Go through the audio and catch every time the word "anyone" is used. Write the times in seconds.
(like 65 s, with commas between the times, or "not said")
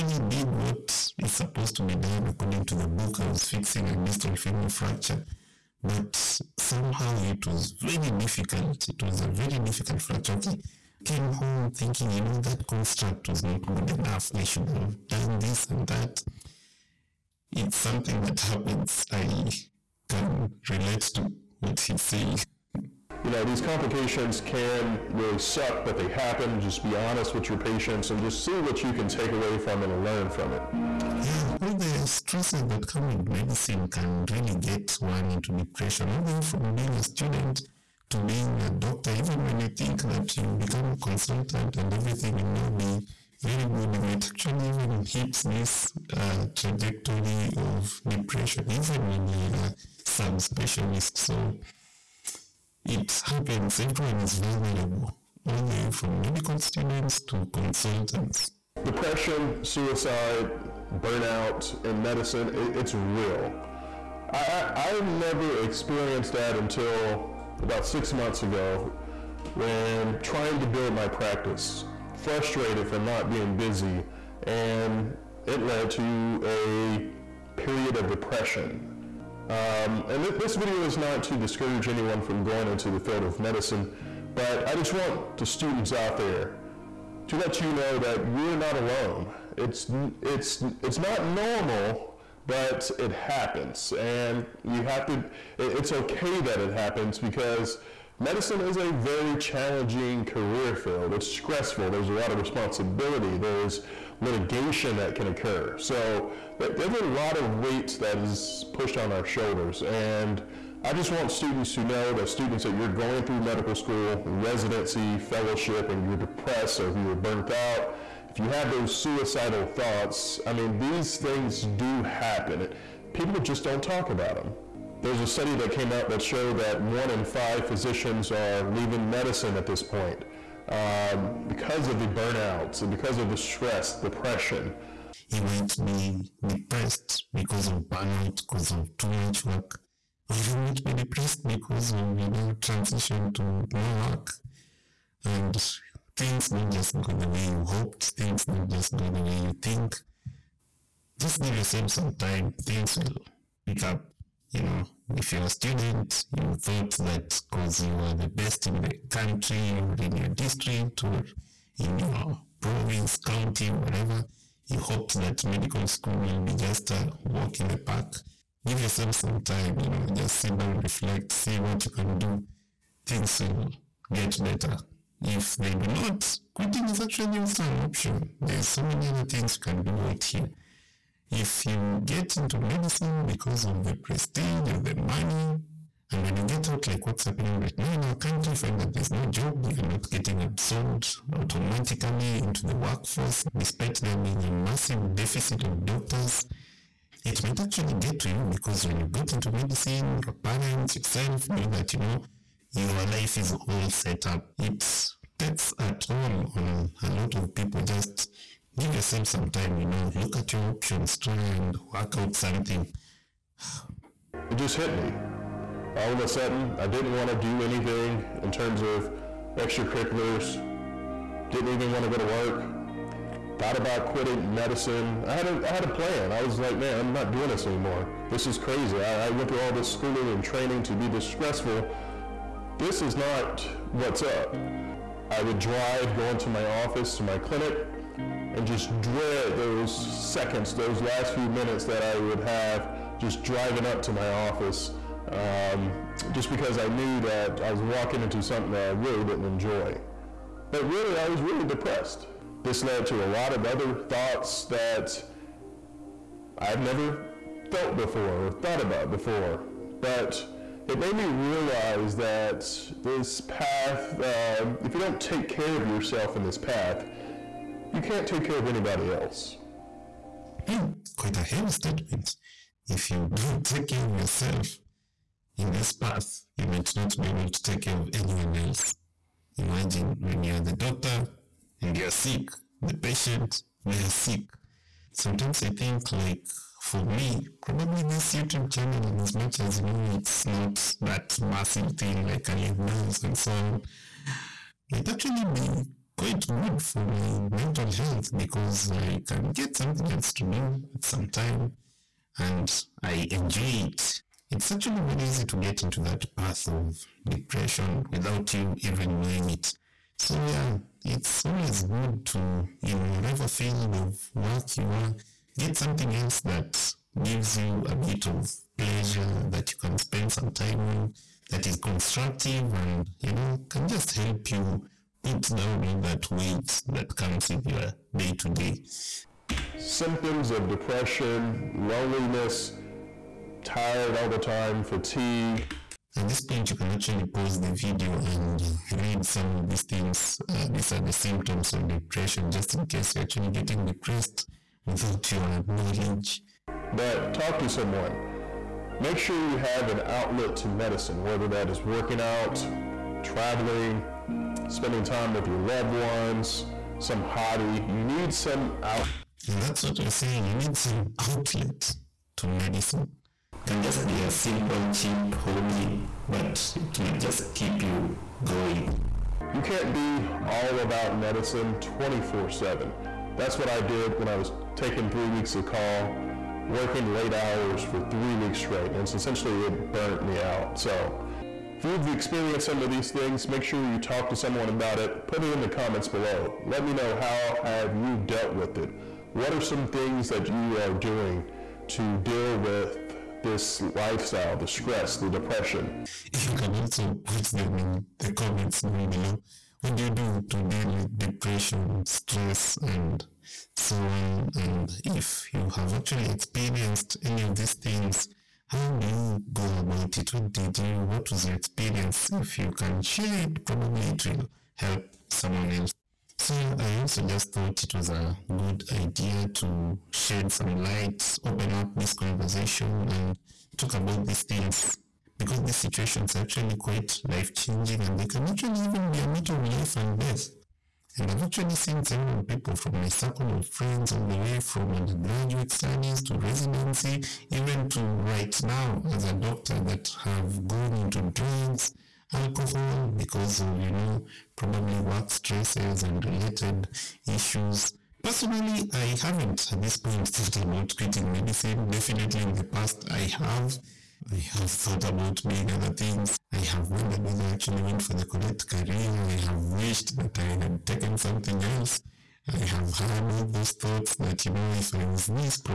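81 s, 278 s.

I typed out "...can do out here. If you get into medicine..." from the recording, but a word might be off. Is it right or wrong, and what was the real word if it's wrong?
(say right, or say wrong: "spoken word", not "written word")
right.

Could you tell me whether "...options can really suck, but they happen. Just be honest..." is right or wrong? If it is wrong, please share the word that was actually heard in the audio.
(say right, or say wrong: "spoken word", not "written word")
wrong: "complications", not "options".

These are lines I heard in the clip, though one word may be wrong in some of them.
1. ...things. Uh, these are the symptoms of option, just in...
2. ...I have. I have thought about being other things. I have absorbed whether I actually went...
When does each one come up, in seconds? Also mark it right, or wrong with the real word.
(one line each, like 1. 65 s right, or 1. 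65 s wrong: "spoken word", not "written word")
1. 339 s wrong: "depression", not "option"
2. 453 s wrong: "wondered", not "absorbed".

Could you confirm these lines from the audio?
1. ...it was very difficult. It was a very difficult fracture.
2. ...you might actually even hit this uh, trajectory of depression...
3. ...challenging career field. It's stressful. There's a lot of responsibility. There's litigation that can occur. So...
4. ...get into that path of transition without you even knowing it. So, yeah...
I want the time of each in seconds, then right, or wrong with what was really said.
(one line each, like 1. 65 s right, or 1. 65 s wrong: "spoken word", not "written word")
1. 7 s right
2. 43 s right
3. 99 s right
4. 305 s wrong: "depression", not "transition".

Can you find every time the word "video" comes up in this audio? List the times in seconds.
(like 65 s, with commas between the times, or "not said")
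80 s, 337 s.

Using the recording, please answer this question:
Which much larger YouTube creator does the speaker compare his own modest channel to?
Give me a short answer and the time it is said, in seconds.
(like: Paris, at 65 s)
Ali Abdaal, at 292 s.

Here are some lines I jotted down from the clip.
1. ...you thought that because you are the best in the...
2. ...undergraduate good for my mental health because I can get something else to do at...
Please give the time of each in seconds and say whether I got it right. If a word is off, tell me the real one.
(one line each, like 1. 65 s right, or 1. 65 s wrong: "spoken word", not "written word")
1. 156 s right
2. 296 s wrong: "quite", not "undergraduate".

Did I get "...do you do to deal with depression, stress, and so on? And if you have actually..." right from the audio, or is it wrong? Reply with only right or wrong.
right.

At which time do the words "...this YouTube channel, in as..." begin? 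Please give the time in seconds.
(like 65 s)
288 s.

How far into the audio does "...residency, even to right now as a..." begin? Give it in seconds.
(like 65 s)
436 s.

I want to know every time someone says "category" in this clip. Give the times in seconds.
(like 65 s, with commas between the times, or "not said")
not said.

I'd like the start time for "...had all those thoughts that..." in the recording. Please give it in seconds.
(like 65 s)
462 s.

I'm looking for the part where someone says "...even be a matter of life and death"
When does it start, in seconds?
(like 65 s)
428 s.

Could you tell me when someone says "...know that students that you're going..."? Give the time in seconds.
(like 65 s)
111 s.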